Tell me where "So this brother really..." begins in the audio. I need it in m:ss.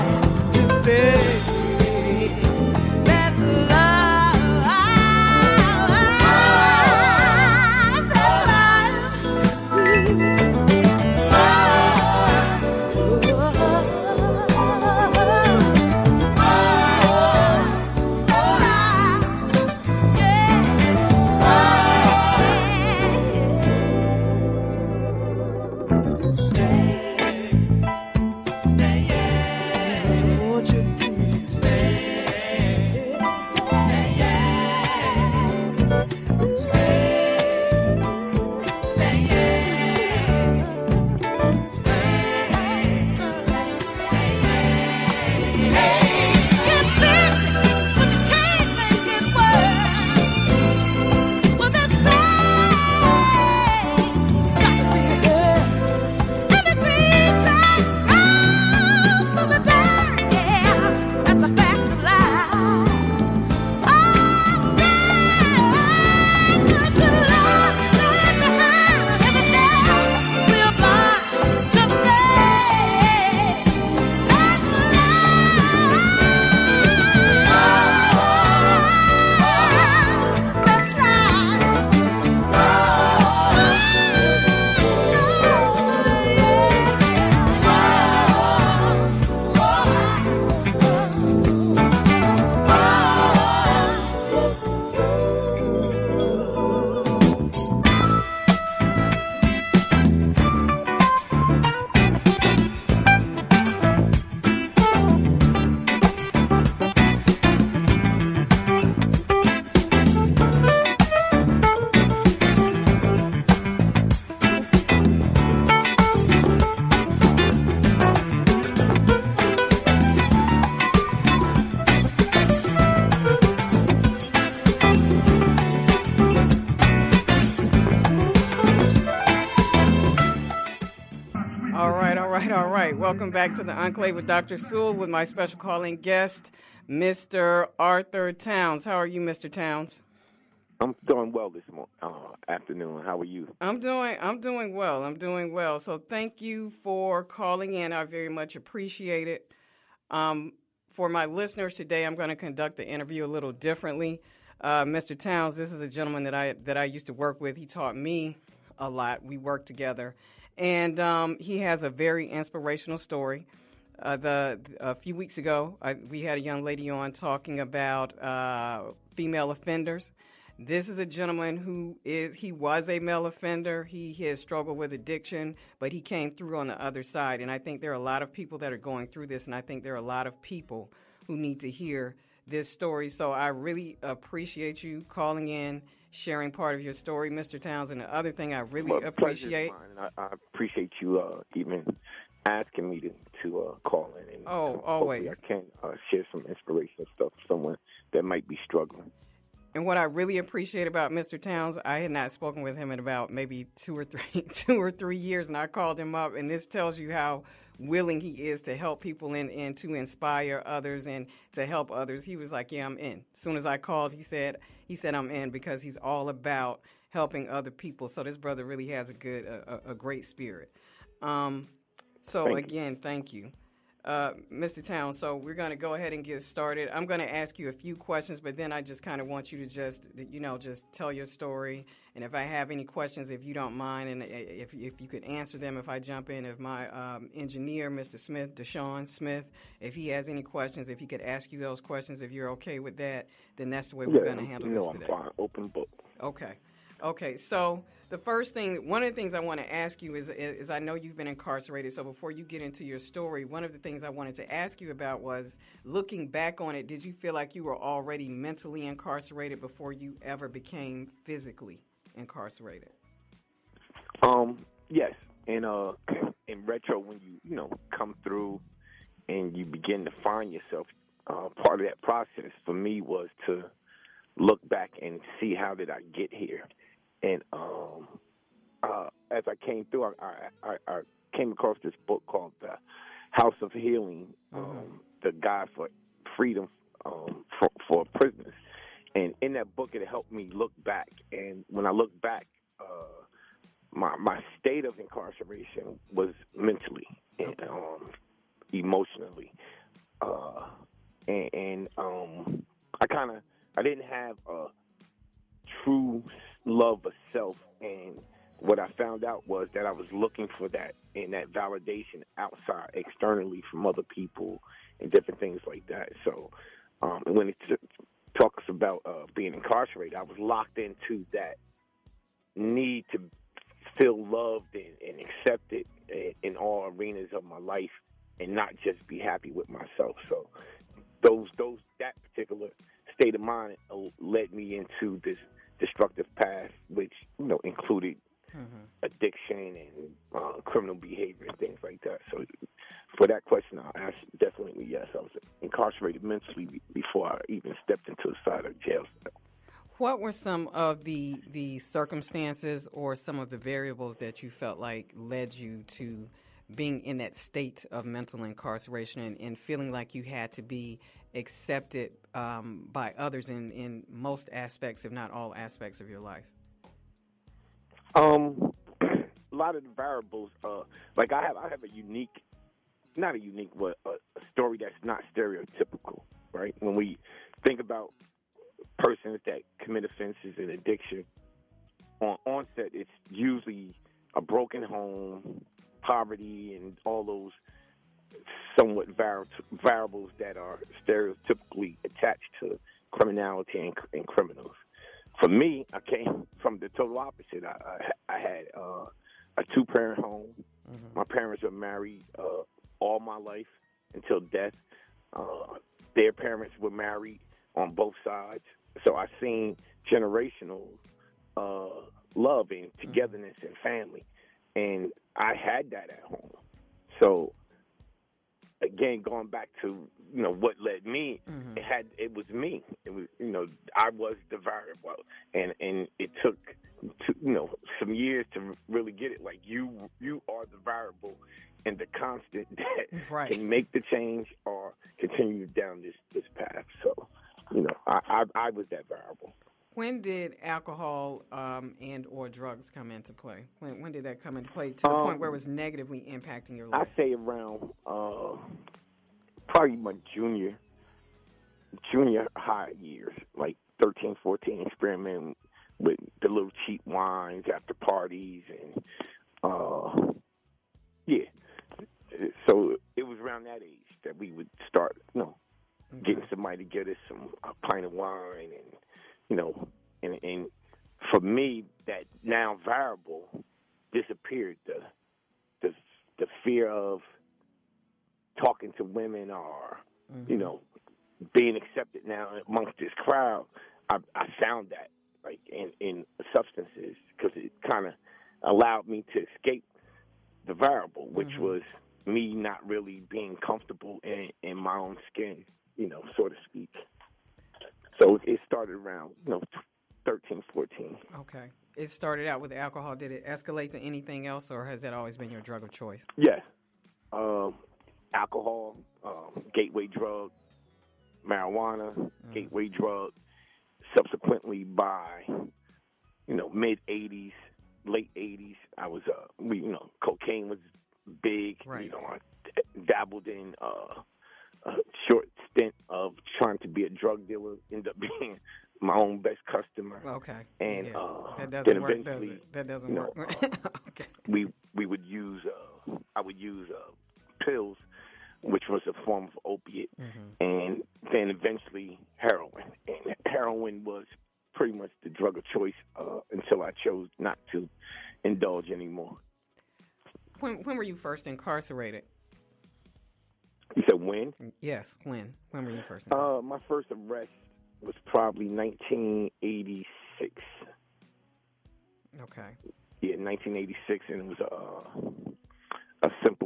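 3:38.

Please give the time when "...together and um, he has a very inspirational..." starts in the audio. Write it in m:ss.
2:39.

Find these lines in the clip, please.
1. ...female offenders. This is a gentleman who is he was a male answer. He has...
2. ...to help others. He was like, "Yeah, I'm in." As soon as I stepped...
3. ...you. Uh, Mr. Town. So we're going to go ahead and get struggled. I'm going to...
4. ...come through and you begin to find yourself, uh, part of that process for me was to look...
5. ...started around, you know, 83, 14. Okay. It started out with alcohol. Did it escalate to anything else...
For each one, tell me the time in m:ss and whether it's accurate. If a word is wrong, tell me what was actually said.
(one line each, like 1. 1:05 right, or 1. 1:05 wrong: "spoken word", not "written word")
1. 2:49 wrong: "offender", not "answer"
2. 3:31 wrong: "called", not "stepped"
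3. 3:43 wrong: "started", not "struggled"
4. 4:27 right
5. 8:18 wrong: "13", not "83".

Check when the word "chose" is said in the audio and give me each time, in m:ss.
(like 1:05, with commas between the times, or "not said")
9:07.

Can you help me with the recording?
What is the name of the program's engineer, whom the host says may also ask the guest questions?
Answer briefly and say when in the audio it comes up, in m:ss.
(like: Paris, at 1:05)
Deshawn Smith, at 3:58.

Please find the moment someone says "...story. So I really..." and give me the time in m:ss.
3:02.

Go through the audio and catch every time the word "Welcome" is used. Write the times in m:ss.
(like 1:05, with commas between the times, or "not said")
2:13.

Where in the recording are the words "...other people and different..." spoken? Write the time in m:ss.
5:13.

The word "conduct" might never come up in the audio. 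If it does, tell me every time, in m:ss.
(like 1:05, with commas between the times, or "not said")
2:32.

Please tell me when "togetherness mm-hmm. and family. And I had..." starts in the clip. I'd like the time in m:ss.
6:53.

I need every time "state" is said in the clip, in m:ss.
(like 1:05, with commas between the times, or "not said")
4:54, 5:33, 5:57.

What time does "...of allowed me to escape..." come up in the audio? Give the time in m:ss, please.
8:08.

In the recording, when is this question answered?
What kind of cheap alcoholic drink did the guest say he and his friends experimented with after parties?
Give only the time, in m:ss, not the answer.
7:36.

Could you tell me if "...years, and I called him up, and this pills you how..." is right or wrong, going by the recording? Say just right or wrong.
wrong.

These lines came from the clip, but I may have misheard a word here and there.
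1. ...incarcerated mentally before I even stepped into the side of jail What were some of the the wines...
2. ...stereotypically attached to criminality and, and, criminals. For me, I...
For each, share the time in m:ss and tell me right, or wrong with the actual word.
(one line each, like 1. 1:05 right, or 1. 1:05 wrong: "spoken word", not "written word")
1. 5:45 wrong: "circumstances", not "wines"
2. 6:31 right.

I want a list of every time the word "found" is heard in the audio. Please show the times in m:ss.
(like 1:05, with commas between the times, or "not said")
5:08, 8:04.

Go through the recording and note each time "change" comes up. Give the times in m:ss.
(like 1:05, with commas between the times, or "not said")
7:14.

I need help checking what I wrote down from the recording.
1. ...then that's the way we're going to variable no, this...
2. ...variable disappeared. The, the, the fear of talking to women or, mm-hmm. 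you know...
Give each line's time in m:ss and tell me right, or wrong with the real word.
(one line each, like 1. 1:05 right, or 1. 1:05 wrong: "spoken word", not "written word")
1. 4:03 wrong: "handle", not "variable"
2. 7:52 right.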